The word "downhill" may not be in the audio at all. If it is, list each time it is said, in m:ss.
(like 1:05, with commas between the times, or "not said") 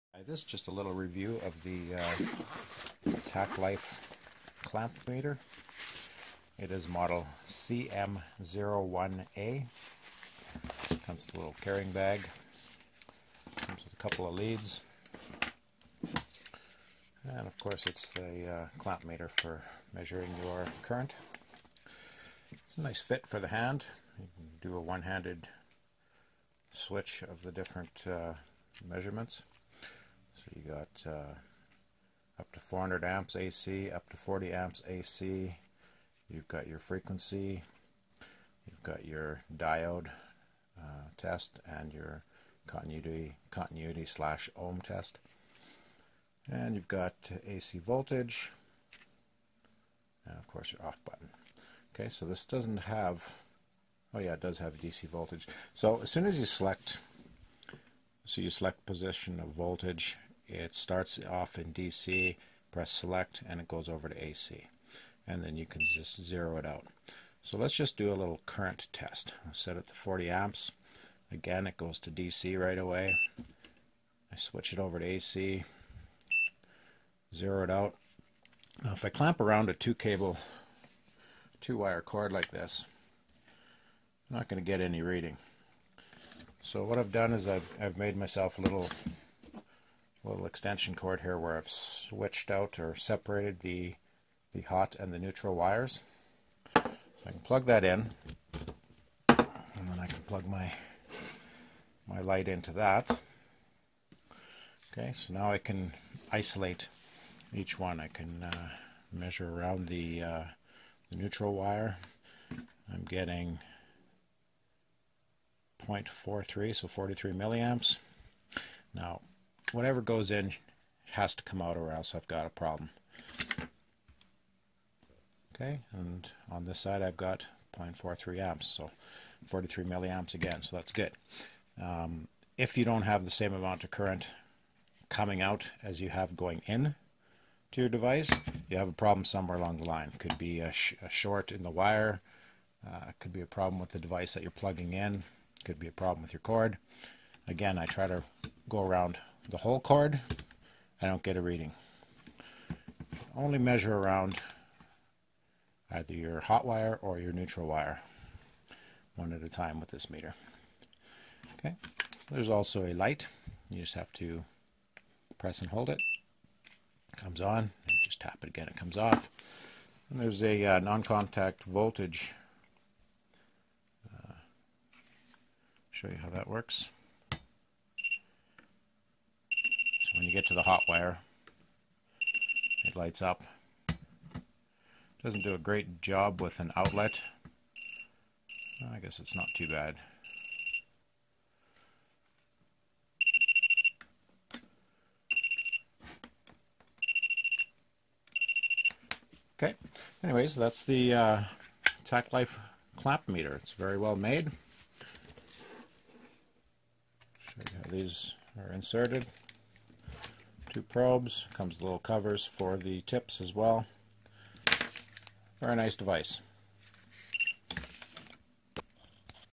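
not said.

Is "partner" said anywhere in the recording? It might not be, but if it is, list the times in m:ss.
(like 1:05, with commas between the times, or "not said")
not said.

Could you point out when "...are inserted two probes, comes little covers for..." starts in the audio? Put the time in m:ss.
3:28.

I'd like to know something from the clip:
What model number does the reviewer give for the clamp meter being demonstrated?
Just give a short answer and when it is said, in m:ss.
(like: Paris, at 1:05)
CM01A, at 0:07.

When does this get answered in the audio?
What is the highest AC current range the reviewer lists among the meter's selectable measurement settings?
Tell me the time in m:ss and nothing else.
0:32.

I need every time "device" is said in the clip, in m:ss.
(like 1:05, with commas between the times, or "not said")
2:17, 2:23, 3:35.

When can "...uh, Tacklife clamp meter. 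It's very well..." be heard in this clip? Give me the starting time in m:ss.
3:21.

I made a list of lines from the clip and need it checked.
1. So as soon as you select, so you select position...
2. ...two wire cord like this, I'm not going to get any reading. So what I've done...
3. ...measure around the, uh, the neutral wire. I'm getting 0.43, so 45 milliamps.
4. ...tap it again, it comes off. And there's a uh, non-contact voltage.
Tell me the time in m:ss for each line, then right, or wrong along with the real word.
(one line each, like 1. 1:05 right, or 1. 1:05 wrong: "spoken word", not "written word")
1. 0:55 right
2. 1:21 right
3. 1:49 wrong: "43", not "45"
4. 2:48 right.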